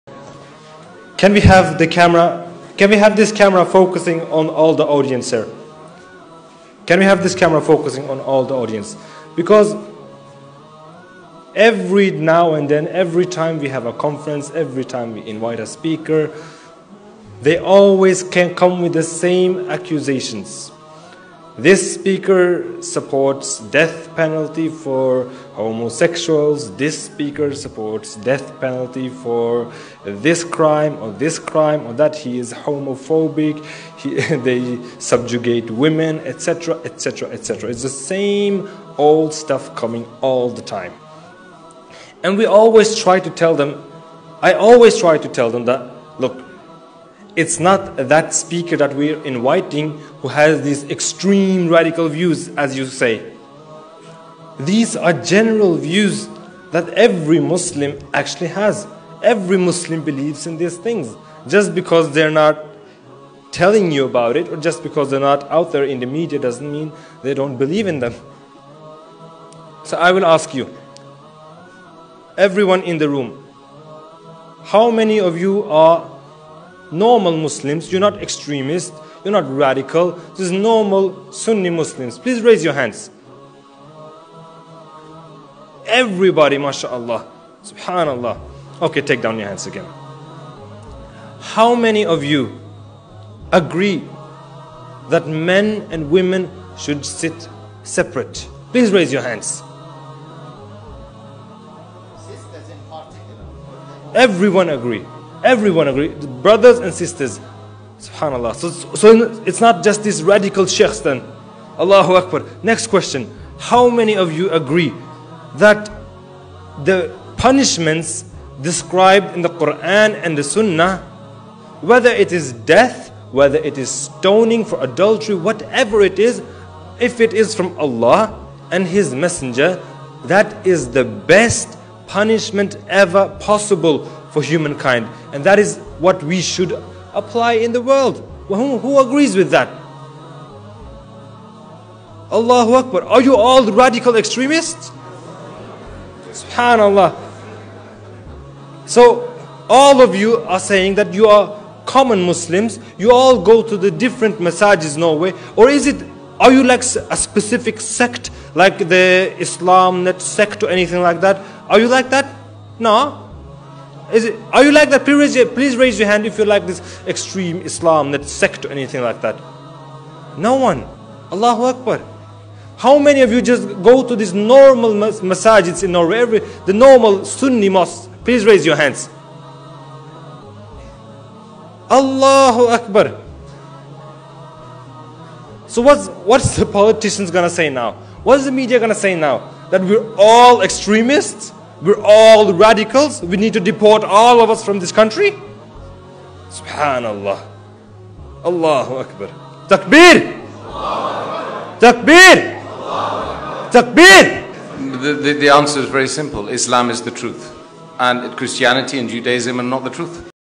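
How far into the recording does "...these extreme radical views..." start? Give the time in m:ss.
0:50.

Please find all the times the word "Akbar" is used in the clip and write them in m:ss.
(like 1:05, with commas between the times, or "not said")
1:52, 2:22, 2:51, 3:02, 3:18.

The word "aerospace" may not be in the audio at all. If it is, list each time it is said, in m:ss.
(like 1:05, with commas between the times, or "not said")
not said.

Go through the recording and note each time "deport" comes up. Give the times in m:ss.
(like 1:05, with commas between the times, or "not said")
3:13.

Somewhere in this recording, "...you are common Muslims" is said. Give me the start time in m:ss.
2:31.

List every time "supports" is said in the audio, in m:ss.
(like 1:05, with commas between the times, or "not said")
0:22, 0:27.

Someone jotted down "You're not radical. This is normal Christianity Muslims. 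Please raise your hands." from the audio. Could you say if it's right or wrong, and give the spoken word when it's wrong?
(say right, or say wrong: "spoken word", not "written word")
wrong: "Sunni", not "Christianity".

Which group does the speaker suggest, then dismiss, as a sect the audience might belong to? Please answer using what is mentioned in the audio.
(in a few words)
IslamNet.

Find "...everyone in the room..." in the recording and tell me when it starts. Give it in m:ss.
1:12.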